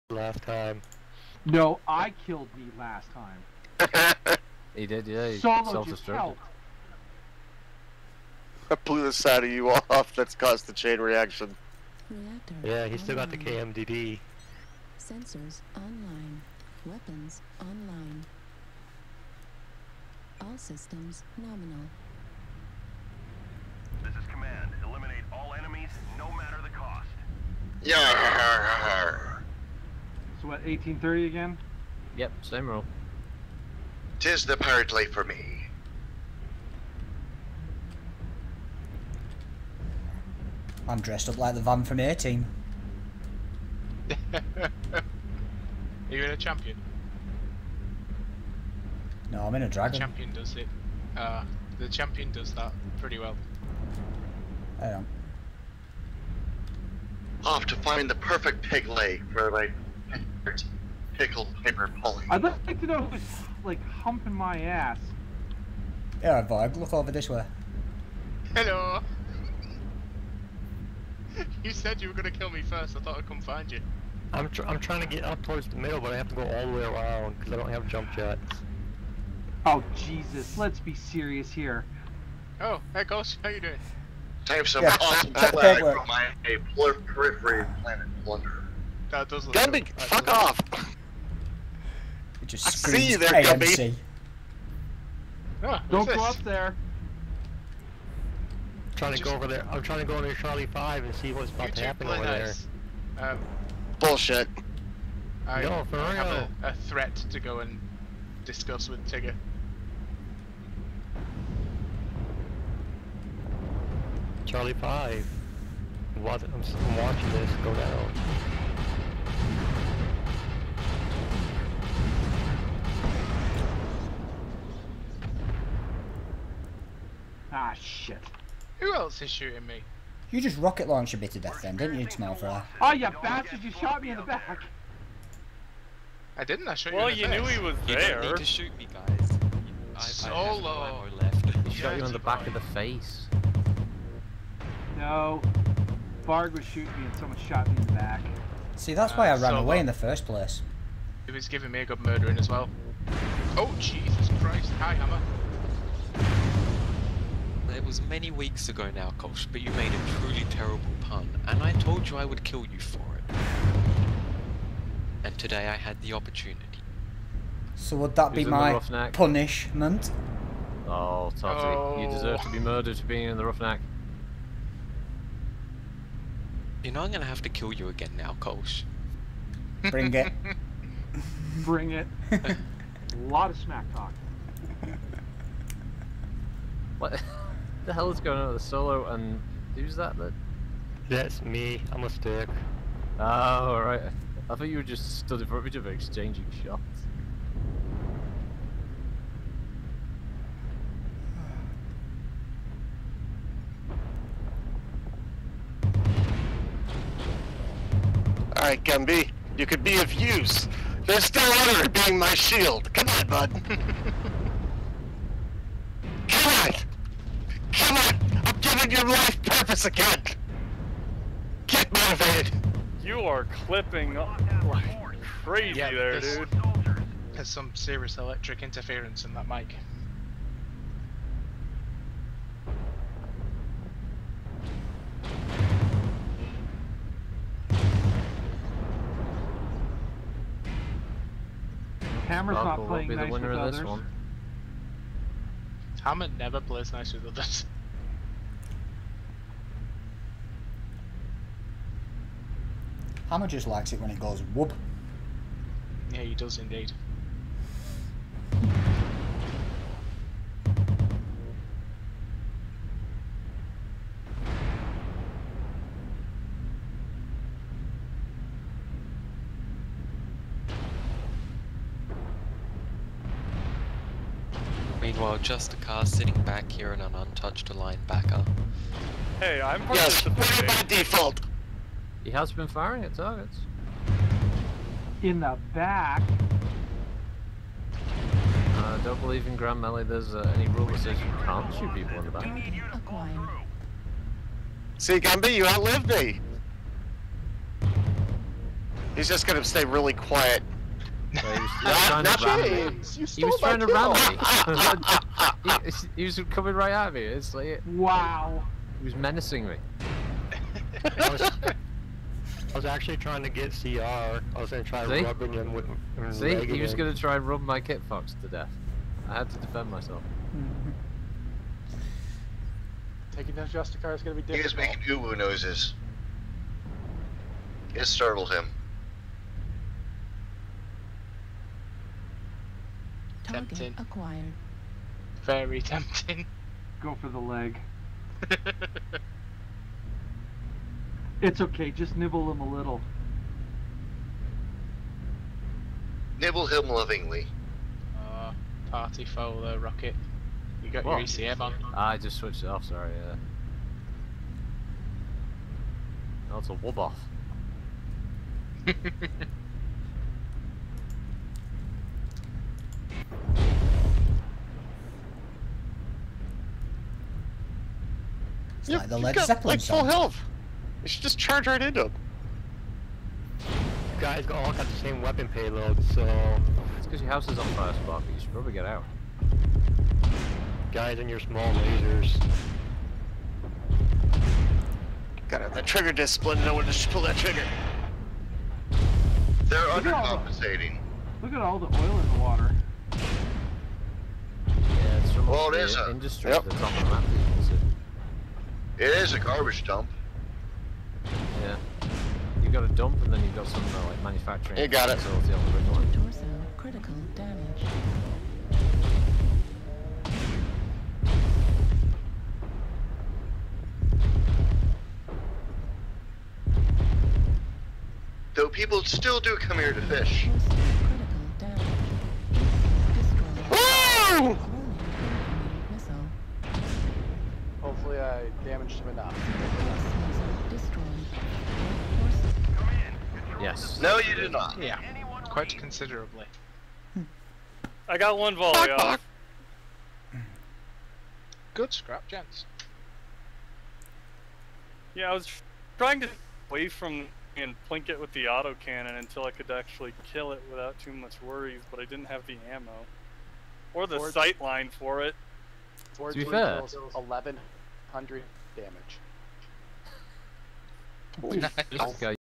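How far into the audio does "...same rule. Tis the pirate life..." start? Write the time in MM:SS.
00:32.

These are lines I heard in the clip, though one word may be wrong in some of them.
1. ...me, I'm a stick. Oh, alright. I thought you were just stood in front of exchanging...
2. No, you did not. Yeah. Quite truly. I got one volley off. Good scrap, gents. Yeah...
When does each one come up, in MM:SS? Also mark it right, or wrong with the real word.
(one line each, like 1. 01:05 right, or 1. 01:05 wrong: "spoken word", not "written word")
1. 03:11 right
2. 07:14 wrong: "considerably", not "truly".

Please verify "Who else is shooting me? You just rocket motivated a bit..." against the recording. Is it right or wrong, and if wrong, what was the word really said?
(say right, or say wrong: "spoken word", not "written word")
wrong: "launched", not "motivated".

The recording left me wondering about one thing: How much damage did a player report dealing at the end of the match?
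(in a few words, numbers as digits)
1100.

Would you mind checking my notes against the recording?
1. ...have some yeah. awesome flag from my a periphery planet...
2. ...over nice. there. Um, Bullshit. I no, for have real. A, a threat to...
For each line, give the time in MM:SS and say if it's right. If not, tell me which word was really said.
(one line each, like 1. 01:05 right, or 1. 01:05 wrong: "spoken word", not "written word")
1. 01:24 right
2. 01:42 right.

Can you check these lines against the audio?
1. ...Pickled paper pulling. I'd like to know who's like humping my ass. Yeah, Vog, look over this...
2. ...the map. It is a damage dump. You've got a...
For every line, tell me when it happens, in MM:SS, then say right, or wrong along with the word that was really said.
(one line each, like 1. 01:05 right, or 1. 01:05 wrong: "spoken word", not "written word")
1. 01:01 right
2. 06:36 wrong: "garbage", not "damage".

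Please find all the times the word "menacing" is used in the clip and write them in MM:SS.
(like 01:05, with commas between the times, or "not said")
05:09.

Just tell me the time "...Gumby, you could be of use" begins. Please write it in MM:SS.
03:28.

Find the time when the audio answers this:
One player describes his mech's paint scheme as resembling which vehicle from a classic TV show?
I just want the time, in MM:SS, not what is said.
00:41.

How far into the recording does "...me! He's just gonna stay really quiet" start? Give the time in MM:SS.
04:56.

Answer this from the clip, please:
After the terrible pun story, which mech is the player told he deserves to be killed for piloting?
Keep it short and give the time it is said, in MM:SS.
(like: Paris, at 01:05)
Roughneck, at 02:53.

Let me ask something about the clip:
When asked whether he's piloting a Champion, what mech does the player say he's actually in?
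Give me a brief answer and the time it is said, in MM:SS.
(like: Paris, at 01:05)
Dragon, at 00:49.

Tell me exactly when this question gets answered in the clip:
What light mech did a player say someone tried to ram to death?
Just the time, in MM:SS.
05:17.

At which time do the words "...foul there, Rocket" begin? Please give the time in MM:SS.
05:49.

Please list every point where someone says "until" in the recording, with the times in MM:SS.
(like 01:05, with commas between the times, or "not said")
07:29.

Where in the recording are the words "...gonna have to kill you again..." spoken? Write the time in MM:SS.
02:57.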